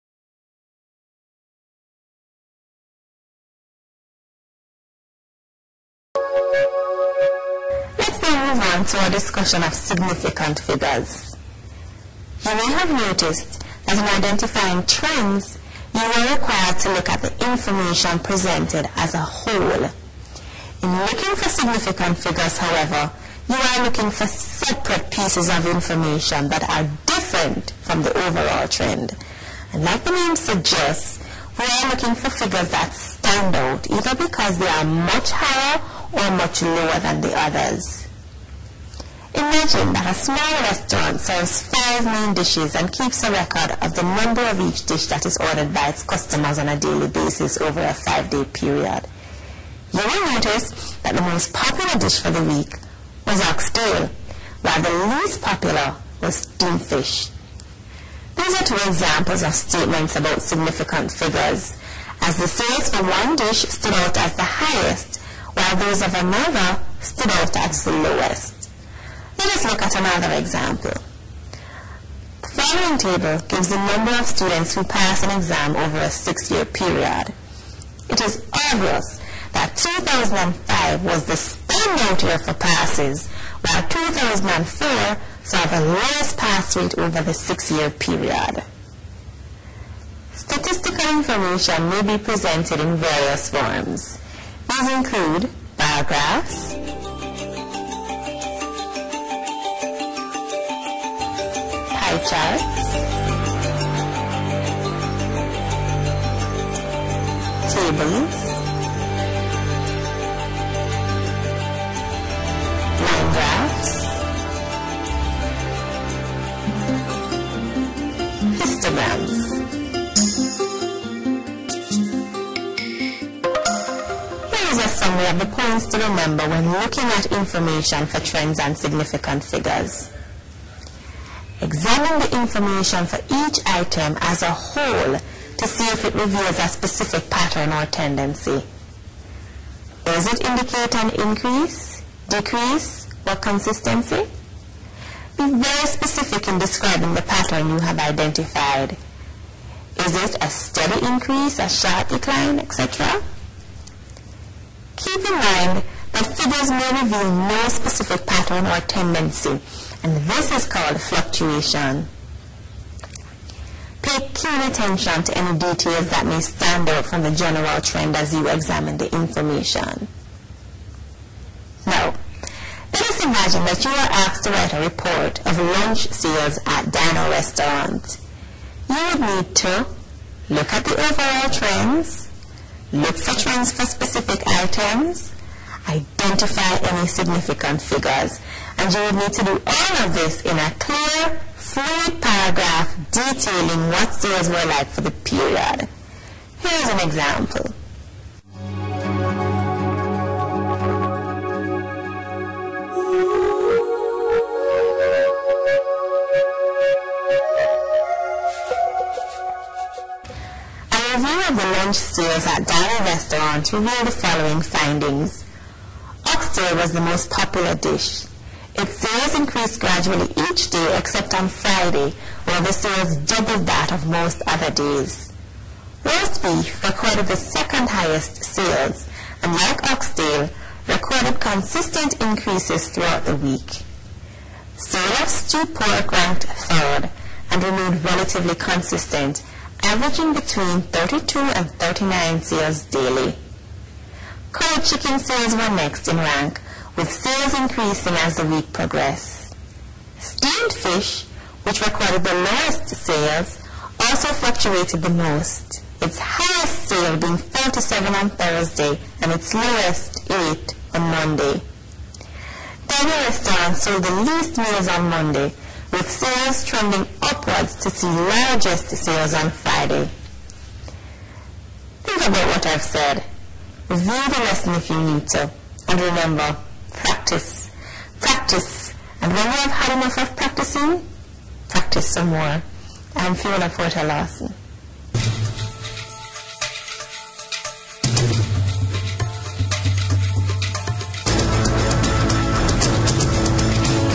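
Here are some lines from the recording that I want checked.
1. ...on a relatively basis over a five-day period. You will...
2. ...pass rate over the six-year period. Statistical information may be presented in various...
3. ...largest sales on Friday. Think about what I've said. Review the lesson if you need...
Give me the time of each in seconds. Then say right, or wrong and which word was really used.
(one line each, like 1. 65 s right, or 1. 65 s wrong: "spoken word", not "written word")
1. 46 s wrong: "daily", not "relatively"
2. 86 s right
3. 268 s right.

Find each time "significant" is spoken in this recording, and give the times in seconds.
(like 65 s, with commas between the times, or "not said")
9 s, 21 s, 60 s, 128 s, 187 s.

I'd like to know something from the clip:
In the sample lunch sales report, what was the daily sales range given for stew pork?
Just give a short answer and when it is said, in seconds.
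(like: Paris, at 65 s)
32 to 39, at 240 s.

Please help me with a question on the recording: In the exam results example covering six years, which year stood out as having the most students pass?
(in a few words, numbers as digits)
2005.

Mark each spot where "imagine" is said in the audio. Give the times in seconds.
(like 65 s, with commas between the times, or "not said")
39 s, 173 s.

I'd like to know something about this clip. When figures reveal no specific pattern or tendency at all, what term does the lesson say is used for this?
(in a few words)
fluctuation.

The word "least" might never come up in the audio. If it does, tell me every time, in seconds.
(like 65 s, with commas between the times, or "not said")
55 s, 264 s.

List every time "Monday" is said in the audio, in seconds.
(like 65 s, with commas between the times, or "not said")
261 s, 265 s.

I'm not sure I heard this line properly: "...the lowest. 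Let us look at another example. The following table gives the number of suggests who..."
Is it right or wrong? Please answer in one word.
wrong.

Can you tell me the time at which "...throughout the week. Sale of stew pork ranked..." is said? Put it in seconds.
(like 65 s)
232 s.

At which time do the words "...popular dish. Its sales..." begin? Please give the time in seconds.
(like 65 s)
217 s.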